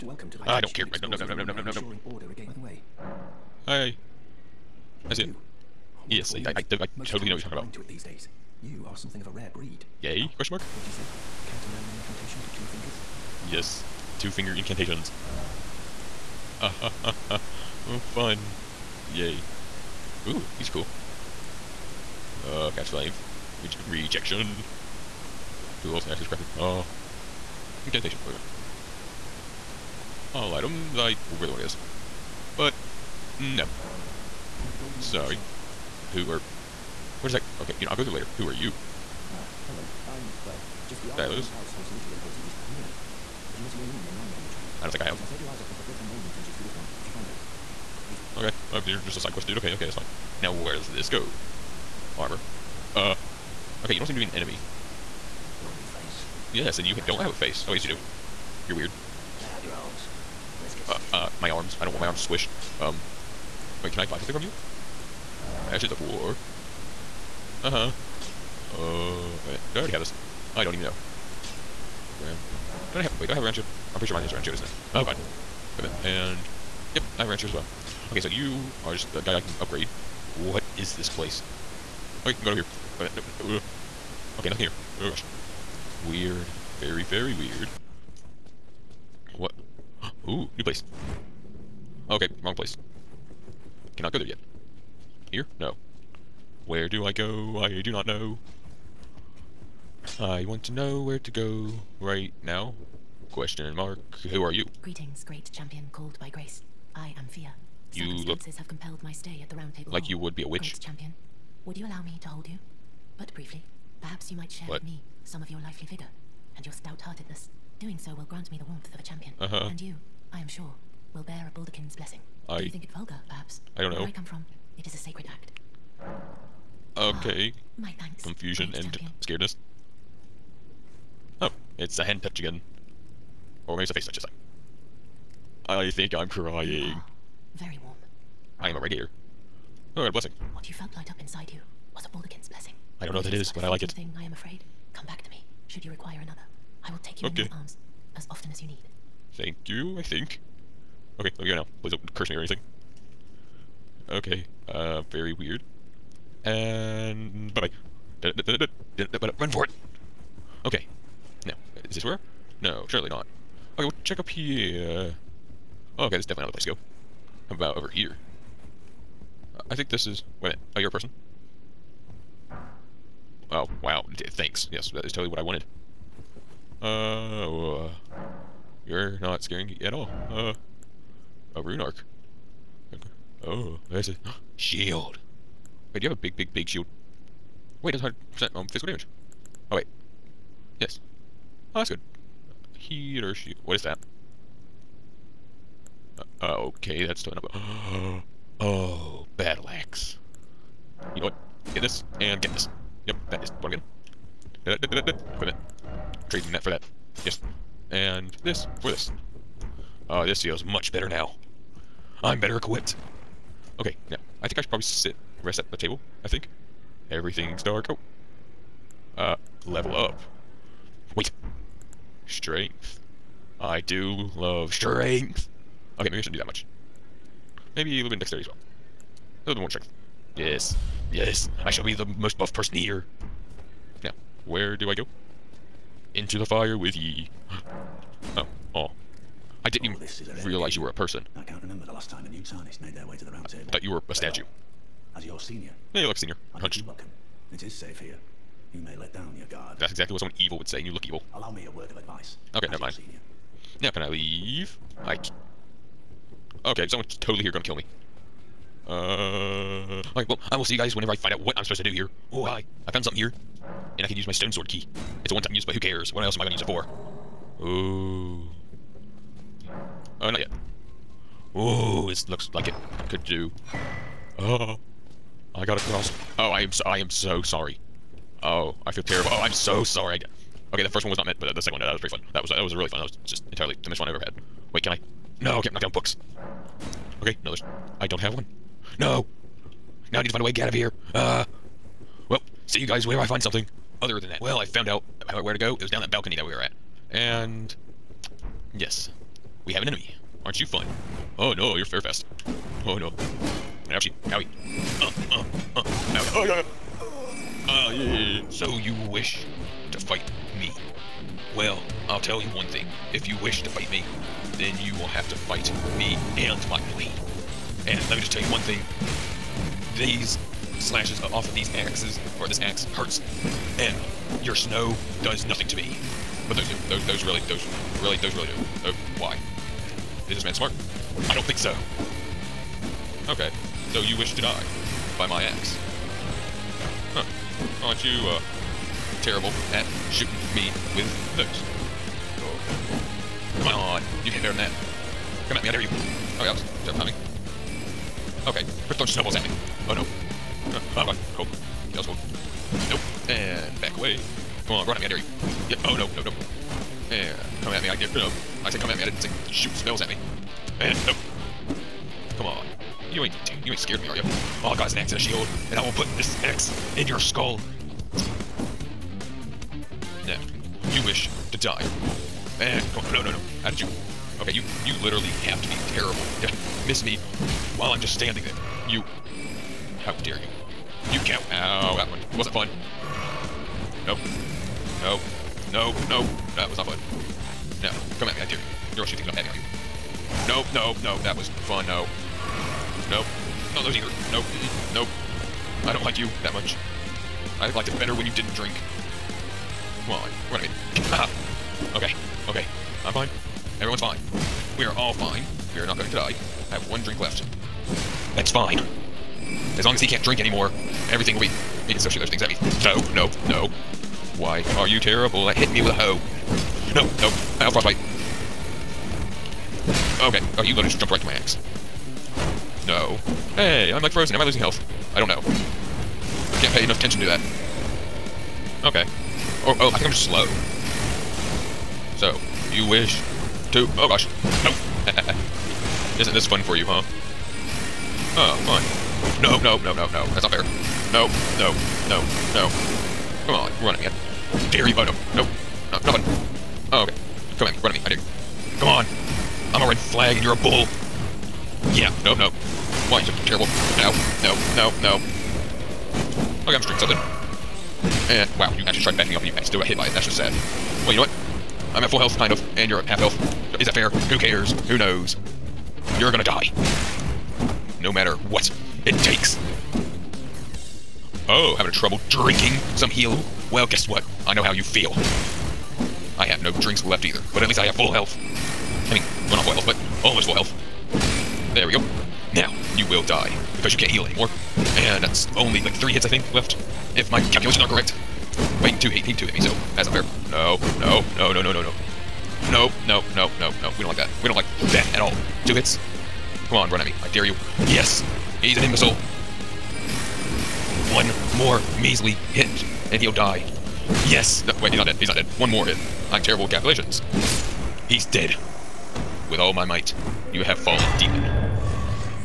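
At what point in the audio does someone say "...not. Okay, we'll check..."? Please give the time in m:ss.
2:43.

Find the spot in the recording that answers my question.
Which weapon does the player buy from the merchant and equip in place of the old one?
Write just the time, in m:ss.
3:19.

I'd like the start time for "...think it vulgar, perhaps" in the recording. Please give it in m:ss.
2:02.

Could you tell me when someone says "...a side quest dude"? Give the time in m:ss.
0:49.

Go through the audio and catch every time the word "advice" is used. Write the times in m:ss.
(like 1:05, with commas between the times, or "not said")
4:11.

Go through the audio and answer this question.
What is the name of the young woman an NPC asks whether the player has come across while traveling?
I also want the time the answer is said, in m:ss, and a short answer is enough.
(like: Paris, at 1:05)
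Lanya, at 0:44.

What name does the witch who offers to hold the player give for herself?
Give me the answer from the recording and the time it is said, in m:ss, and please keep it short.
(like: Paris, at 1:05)
Fia, at 1:47.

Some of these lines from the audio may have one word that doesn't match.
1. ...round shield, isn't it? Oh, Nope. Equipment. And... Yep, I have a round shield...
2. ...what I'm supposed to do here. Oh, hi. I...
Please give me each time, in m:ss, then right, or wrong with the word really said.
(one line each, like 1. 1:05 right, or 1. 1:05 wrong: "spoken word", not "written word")
1. 1:14 wrong: "God", not "Nope"
2. 4:21 right.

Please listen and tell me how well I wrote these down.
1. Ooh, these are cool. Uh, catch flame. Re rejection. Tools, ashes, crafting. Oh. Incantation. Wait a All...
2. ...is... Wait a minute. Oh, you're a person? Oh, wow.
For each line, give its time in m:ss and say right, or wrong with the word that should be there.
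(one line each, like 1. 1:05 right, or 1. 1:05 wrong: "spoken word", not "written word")
1. 0:20 right
2. 2:50 right.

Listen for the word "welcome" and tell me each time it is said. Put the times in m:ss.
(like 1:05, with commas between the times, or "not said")
0:00, 4:06.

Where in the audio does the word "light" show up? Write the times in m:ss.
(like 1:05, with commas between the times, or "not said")
2:20.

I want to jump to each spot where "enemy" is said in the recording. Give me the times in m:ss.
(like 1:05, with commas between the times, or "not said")
0:54, 4:59.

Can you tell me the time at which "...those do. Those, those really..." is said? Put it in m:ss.
5:26.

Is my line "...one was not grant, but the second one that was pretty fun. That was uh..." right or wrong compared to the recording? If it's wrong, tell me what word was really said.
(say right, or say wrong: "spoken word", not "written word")
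wrong: "meant", not "grant".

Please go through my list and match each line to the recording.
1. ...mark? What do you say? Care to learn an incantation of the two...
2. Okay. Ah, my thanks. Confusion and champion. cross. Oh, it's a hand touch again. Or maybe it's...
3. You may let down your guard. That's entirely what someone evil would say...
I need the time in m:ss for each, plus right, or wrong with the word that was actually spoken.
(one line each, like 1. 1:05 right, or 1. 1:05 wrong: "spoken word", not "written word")
1. 0:10 right
2. 2:06 wrong: "scaredness", not "cross"
3. 4:08 wrong: "exactly", not "entirely".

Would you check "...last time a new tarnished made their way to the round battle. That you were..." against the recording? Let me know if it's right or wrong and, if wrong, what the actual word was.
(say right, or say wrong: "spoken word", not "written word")
wrong: "table", not "battle".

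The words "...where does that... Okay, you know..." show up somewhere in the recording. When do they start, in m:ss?
0:37.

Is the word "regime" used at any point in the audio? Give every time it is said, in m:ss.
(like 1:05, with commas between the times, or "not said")
not said.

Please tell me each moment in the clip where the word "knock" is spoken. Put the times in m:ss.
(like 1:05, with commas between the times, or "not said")
4:45.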